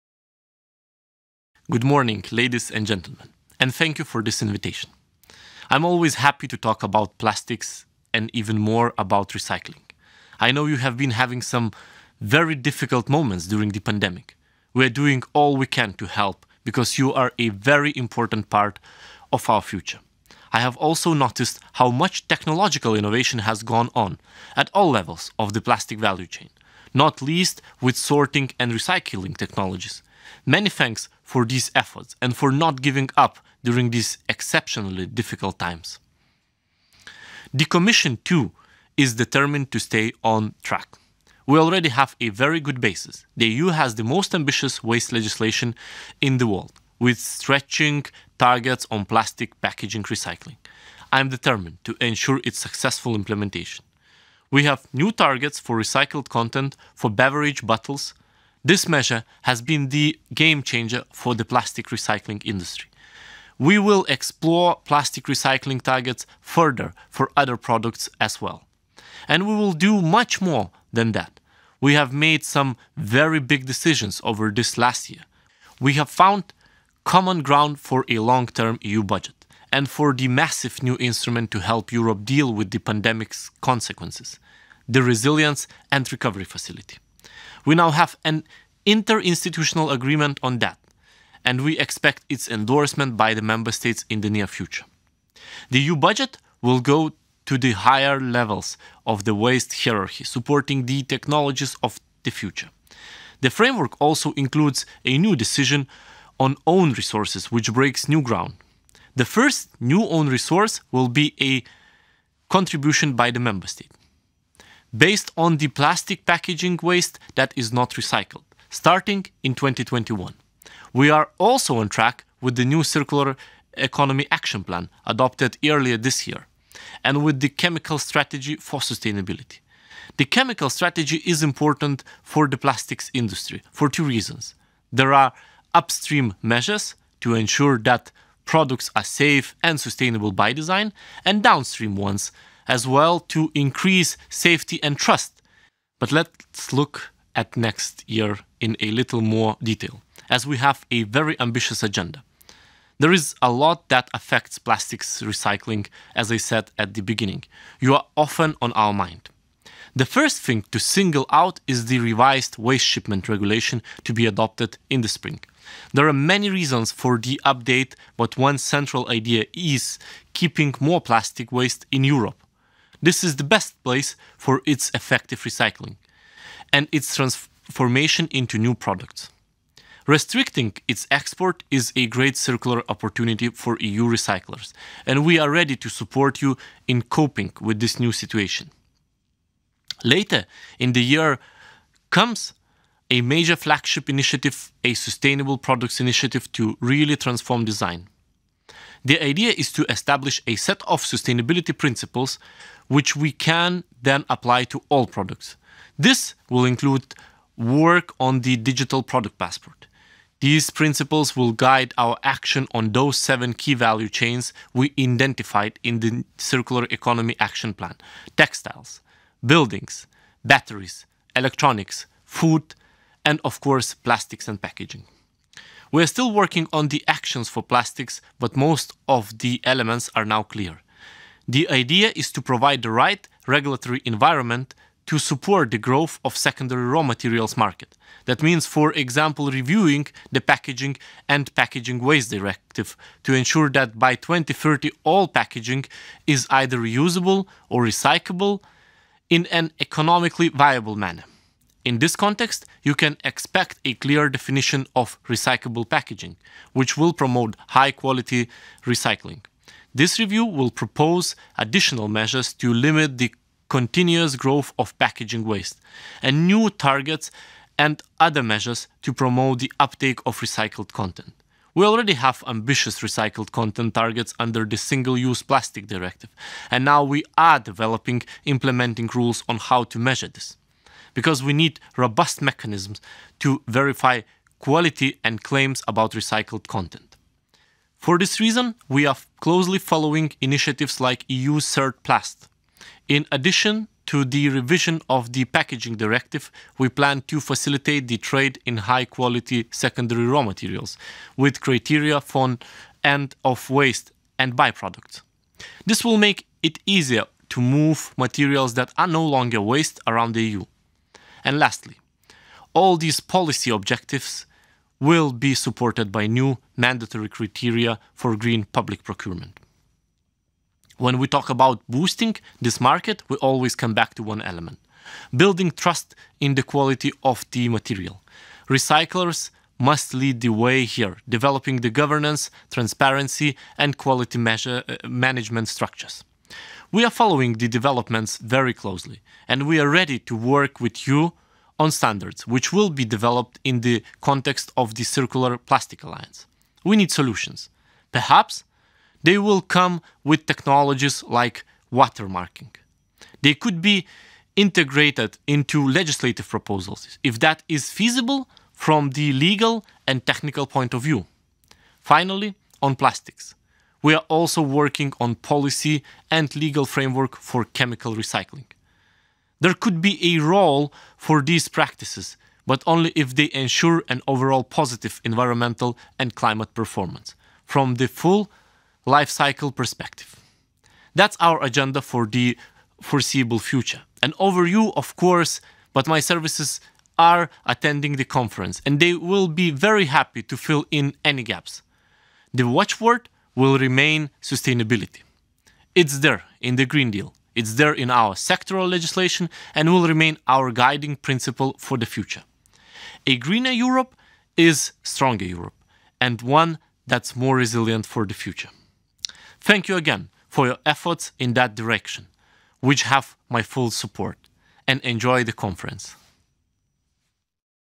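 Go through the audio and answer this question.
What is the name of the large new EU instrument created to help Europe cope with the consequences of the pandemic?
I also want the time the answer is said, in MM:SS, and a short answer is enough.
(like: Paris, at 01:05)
Resilience and Recovery Facility, at 01:25.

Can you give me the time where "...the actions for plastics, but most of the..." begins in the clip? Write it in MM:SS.
03:46.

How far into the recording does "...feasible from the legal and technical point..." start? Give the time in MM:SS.
05:57.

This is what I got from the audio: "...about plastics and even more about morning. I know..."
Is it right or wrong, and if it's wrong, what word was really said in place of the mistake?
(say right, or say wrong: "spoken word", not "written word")
wrong: "recycling", not "morning".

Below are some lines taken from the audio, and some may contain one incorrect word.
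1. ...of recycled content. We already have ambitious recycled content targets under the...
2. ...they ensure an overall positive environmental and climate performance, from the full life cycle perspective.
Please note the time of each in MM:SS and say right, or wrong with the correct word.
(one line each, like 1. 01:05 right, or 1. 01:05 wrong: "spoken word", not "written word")
1. 04:30 right
2. 06:13 right.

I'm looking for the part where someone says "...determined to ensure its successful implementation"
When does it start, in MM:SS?
00:51.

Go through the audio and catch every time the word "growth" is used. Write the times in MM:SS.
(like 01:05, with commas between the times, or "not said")
03:55, 04:24.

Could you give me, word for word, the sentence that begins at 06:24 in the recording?
An overview, of course, but my services are attending the conference and they will be very happy to fill in any gaps.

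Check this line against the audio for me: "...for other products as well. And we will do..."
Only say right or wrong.
right.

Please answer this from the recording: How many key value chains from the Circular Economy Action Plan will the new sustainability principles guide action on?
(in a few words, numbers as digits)
7.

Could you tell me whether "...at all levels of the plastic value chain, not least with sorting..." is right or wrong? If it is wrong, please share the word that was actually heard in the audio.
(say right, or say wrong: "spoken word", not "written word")
right.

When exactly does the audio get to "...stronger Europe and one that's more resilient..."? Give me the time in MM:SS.
06:45.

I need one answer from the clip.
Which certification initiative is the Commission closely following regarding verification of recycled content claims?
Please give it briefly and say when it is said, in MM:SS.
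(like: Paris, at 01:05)
EuCertPlast, at 04:51.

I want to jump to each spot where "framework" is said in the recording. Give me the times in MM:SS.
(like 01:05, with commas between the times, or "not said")
01:43, 06:06.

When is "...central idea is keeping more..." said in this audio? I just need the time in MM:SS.
02:48.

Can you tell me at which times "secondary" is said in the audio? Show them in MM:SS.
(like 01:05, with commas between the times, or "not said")
03:56, 04:59.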